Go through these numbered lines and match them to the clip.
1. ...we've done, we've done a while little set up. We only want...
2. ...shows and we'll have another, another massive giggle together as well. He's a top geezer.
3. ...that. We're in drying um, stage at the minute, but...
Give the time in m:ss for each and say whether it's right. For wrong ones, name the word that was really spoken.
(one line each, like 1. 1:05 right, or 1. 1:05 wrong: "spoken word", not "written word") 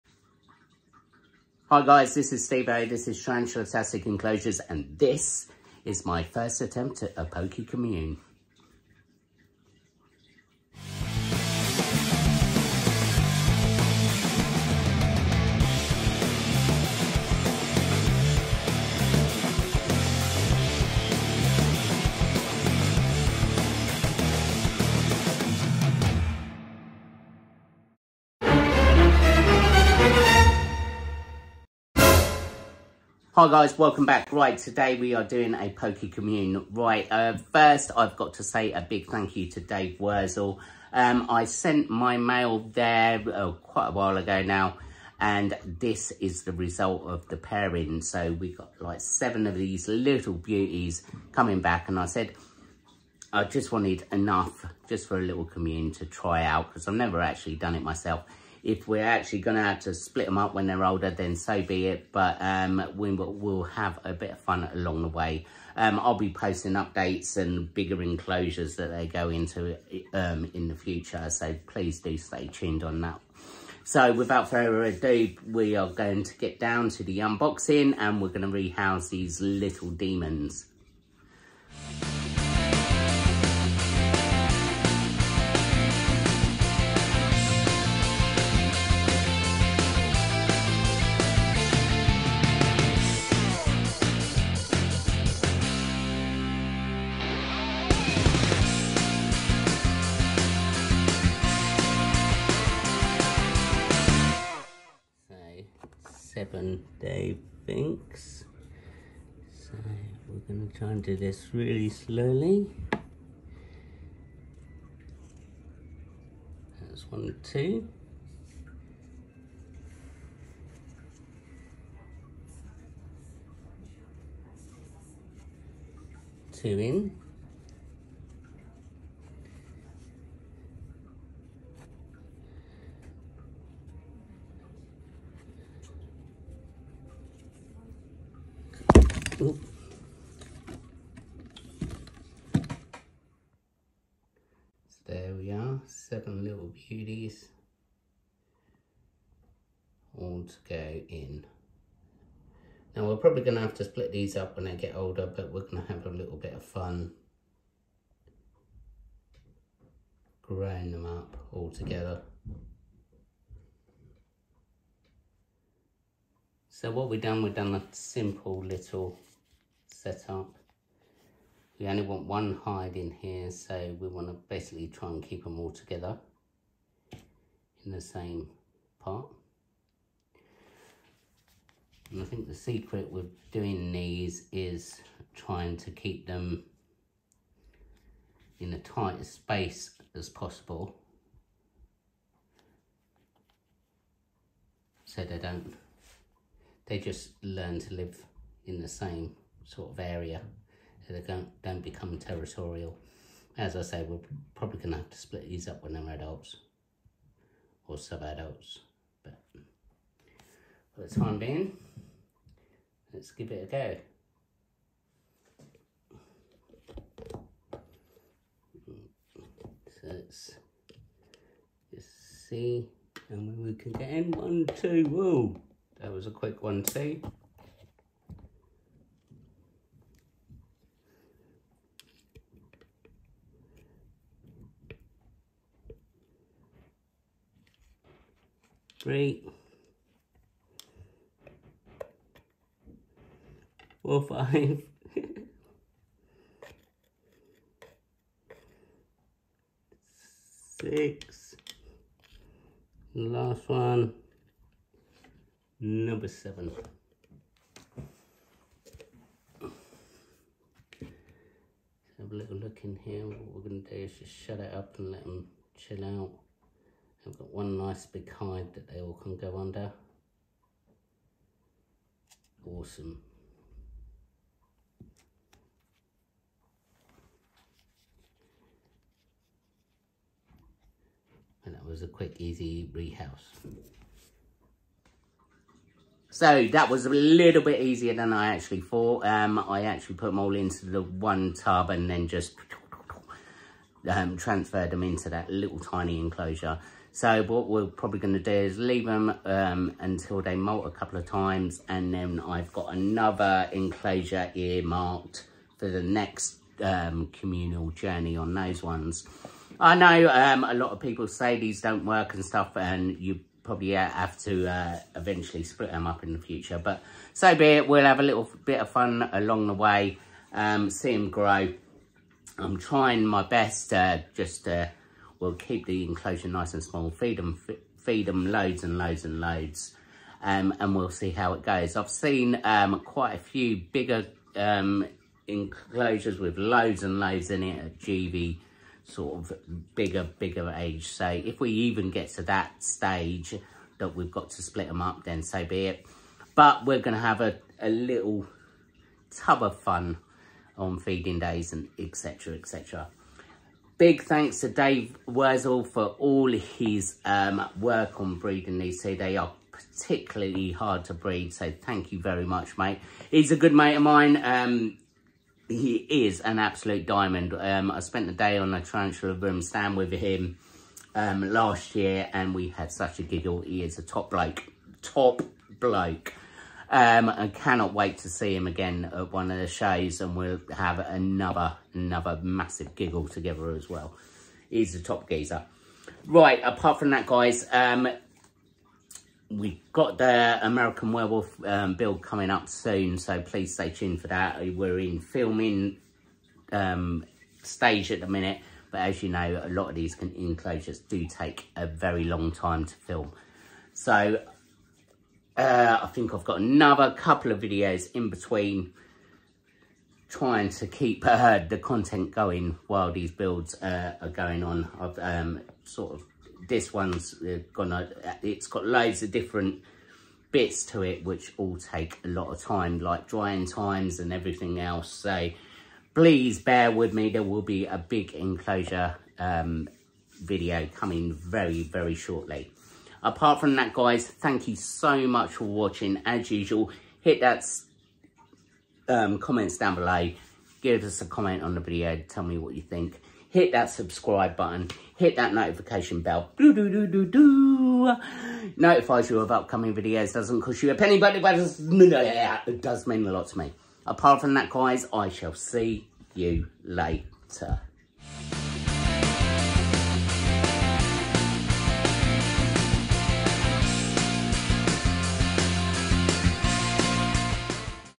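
1. 2:47 wrong: "simple", not "while"
2. 6:19 right
3. 6:34 wrong: "filming", not "drying".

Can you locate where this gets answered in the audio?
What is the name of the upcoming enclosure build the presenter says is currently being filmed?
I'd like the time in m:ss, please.
6:30.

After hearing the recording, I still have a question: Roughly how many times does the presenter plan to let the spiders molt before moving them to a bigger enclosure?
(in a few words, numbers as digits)
2.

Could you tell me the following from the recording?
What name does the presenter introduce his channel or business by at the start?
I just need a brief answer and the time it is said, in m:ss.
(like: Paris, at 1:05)
Tarantula Tastic Enclosures, at 0:03.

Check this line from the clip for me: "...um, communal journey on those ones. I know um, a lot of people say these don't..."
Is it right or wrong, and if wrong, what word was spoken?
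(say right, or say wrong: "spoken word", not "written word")
right.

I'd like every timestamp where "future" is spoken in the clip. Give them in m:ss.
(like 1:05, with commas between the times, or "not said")
1:10, 5:16.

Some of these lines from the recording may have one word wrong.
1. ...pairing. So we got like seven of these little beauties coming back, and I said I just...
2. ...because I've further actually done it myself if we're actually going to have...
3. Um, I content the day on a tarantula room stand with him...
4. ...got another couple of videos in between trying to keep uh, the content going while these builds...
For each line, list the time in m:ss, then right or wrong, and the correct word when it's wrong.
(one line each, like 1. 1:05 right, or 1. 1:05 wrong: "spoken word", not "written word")
1. 0:47 right
2. 0:56 wrong: "never", not "further"
3. 6:07 wrong: "spent", not "content"
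4. 6:46 right.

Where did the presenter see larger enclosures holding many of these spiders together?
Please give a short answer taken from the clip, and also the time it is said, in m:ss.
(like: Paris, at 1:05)
GV, at 5:37.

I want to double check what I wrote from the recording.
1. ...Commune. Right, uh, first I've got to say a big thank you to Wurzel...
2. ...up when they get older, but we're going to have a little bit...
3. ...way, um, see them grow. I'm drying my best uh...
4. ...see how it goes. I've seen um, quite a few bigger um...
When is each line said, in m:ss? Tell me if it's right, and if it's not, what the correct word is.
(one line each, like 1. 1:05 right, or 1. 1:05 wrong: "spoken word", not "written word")
1. 0:36 wrong: "Dave", not "Wurzel"
2. 2:34 right
3. 5:19 wrong: "trying", not "drying"
4. 5:31 right.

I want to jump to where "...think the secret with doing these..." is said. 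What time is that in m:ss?
3:02.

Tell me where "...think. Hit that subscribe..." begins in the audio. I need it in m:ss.
7:22.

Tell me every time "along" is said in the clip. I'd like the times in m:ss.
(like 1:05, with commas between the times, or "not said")
1:04, 5:19.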